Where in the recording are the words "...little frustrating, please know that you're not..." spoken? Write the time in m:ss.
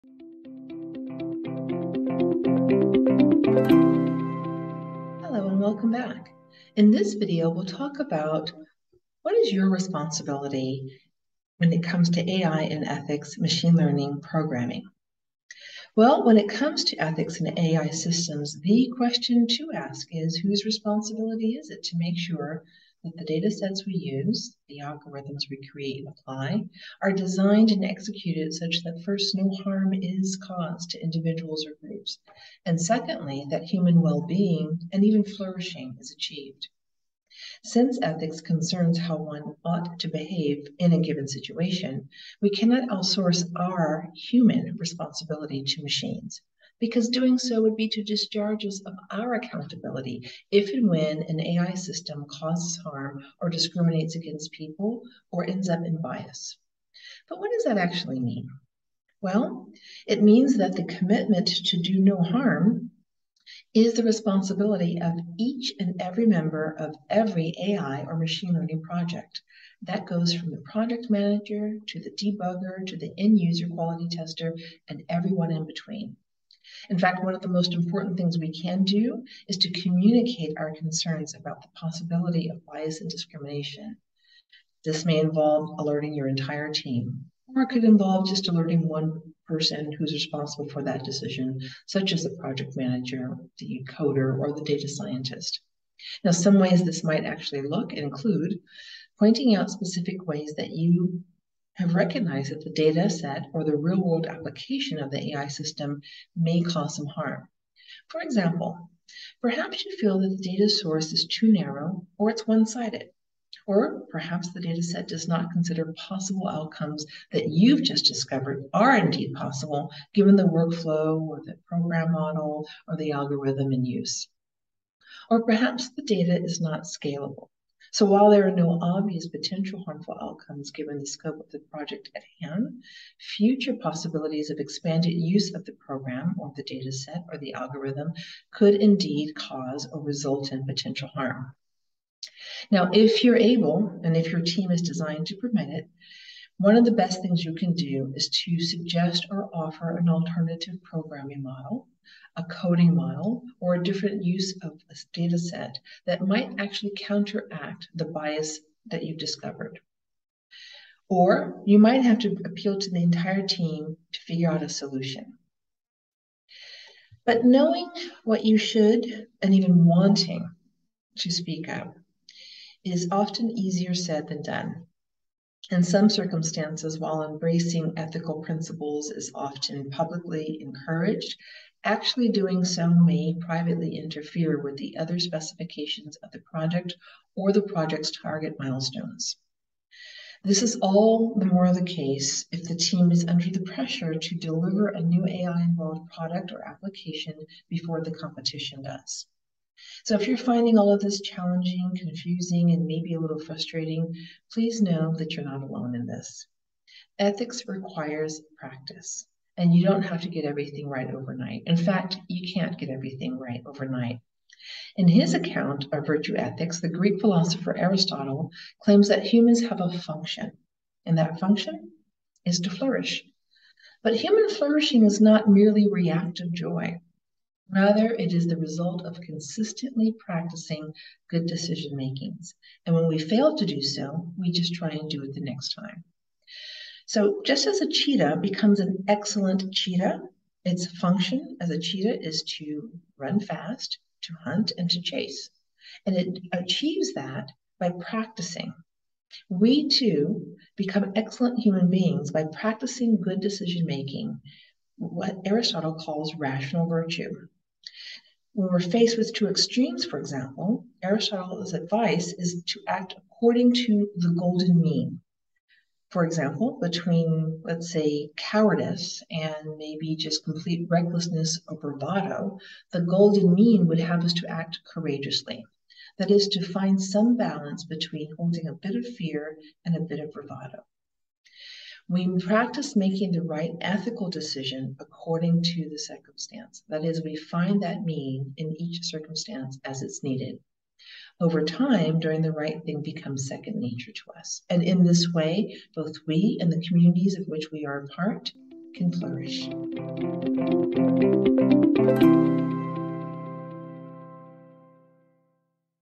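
3:23.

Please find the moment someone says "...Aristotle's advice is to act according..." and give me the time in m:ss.
4:21.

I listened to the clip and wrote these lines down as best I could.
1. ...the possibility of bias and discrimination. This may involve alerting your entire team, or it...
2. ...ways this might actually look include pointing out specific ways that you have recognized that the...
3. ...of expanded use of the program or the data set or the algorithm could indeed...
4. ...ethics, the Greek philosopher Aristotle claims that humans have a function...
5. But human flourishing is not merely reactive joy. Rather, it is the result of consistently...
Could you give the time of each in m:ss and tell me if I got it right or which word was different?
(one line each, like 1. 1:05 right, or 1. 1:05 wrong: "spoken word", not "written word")
1. 1:21 right
2. 1:36 right
3. 2:14 right
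4. 3:36 right
5. 3:44 right.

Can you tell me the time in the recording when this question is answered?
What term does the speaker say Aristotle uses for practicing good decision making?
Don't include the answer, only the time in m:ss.
4:16.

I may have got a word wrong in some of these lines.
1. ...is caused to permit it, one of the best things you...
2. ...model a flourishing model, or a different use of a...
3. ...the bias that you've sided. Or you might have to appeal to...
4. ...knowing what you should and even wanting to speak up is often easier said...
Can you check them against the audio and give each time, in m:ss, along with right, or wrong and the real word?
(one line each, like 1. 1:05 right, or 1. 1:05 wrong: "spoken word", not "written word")
1. 2:24 wrong: "designed", not "caused"
2. 2:31 wrong: "coding", not "flourishing"
3. 2:37 wrong: "discovered", not "sided"
4. 2:47 right.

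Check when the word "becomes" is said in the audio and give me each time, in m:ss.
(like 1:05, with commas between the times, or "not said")
3:58, 4:10, 4:53.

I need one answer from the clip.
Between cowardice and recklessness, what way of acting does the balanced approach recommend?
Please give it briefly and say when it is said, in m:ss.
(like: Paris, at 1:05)
Courageously, at 4:34.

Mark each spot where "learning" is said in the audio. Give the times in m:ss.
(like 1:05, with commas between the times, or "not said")
0:13, 1:08.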